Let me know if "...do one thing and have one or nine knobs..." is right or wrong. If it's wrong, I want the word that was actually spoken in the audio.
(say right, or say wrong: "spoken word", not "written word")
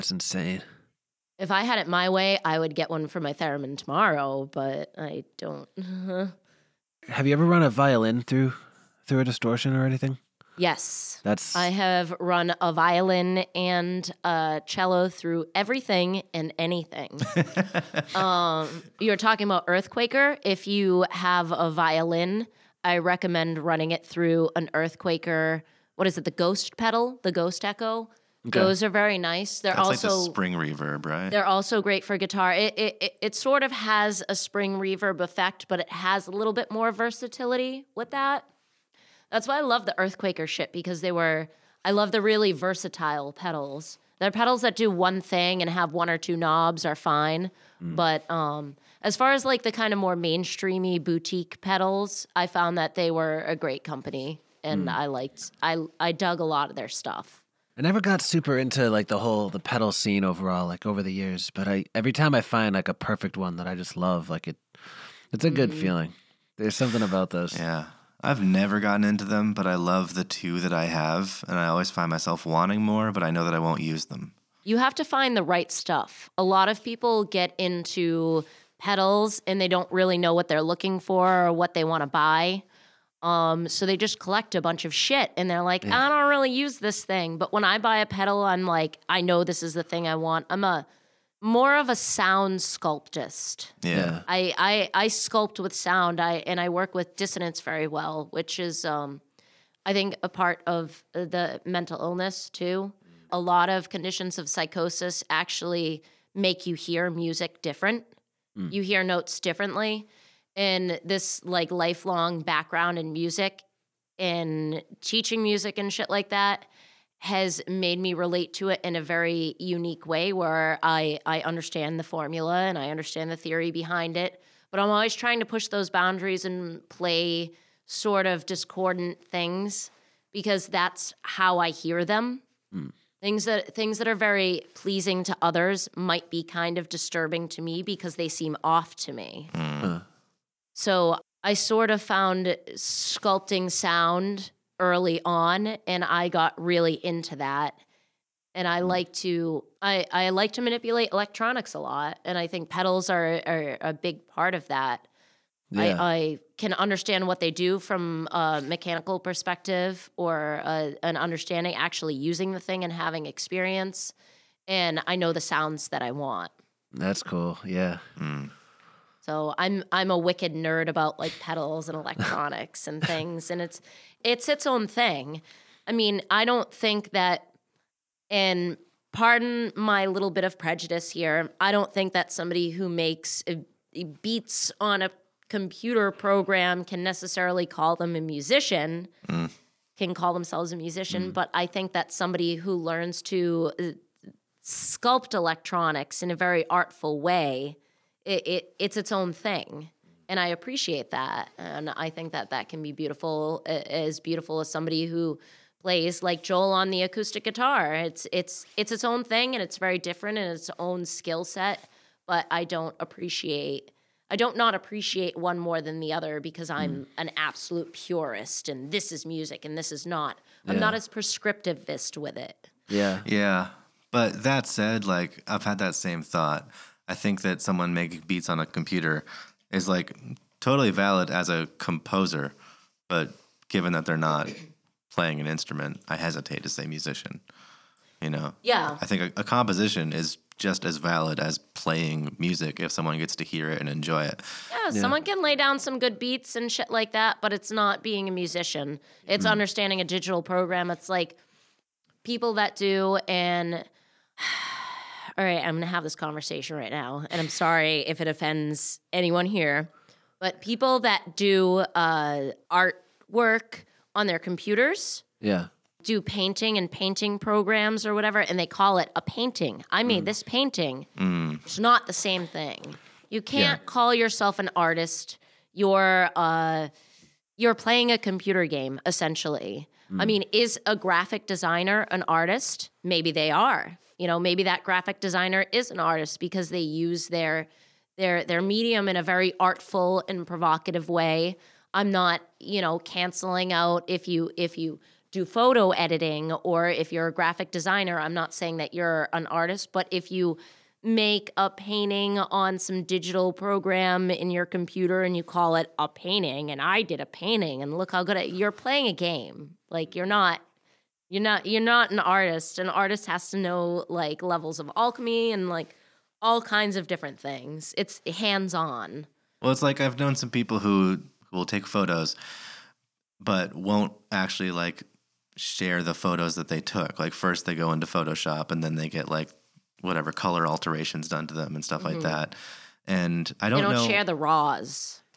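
wrong: "two", not "nine".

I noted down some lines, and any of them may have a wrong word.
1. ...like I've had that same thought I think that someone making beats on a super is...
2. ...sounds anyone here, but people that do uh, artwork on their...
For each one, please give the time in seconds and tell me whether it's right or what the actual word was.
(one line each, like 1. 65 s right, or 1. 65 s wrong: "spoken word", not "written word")
1. 225 s wrong: "computer", not "super"
2. 258 s wrong: "offends", not "sounds".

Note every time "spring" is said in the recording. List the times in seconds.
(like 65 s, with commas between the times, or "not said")
30 s, 34 s.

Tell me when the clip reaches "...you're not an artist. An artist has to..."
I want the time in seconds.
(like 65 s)
311 s.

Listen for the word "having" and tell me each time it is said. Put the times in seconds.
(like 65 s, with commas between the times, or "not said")
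162 s.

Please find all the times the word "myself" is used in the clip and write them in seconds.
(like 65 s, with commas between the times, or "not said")
72 s.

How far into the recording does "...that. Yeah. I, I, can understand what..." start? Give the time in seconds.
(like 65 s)
154 s.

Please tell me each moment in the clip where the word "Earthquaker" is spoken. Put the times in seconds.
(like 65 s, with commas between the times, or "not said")
19 s, 24 s, 39 s.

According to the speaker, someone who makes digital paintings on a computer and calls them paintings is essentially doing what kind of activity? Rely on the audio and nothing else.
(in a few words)
playing a computer game.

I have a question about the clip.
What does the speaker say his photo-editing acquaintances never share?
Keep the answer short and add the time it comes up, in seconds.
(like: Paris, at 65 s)
the raws, at 334 s.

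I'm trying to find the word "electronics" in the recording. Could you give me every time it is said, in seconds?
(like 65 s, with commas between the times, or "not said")
151 s, 171 s, 195 s.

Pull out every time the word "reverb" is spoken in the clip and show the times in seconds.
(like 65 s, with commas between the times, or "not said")
30 s, 34 s.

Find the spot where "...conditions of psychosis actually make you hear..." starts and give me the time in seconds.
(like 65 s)
103 s.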